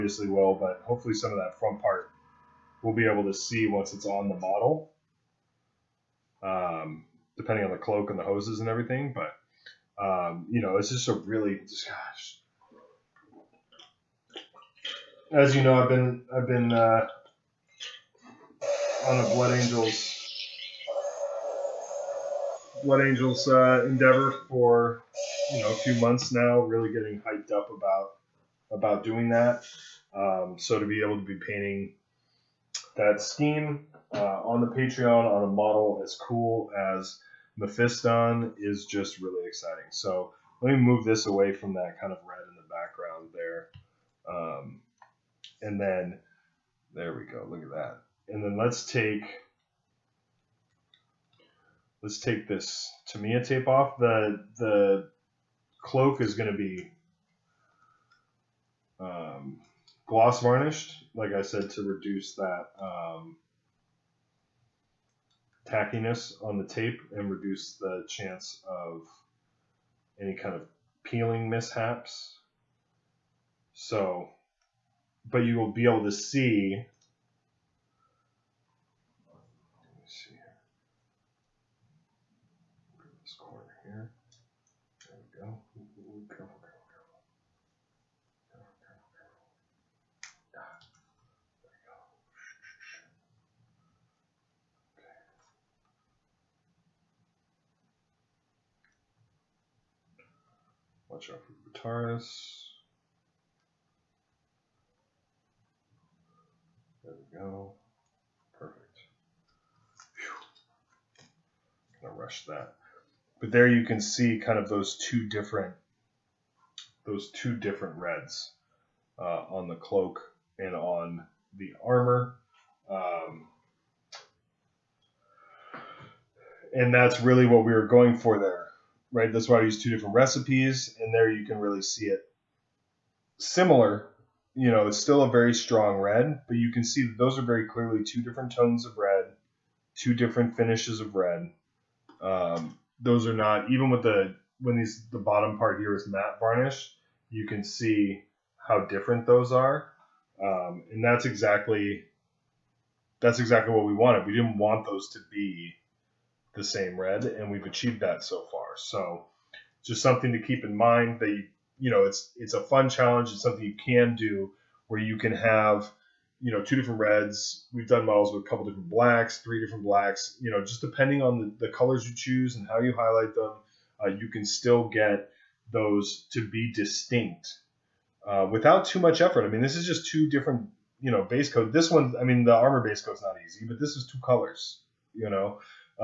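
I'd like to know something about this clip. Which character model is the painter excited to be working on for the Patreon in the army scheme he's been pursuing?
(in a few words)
Mephiston.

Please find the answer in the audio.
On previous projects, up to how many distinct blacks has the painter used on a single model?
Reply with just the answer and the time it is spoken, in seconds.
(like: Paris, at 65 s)
3, at 169 s.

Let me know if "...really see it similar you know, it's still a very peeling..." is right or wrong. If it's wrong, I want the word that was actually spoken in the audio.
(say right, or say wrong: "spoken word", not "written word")
wrong: "strong", not "peeling".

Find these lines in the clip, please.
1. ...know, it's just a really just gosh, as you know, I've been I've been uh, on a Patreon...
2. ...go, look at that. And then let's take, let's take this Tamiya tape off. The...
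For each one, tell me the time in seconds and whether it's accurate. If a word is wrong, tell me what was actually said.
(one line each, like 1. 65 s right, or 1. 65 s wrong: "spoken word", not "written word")
1. 10 s wrong: "Blood", not "Patreon"
2. 47 s right.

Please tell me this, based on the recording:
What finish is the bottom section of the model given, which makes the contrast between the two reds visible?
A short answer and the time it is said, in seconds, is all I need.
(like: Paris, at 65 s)
Matte varnish, at 146 s.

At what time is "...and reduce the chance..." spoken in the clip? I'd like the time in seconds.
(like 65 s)
67 s.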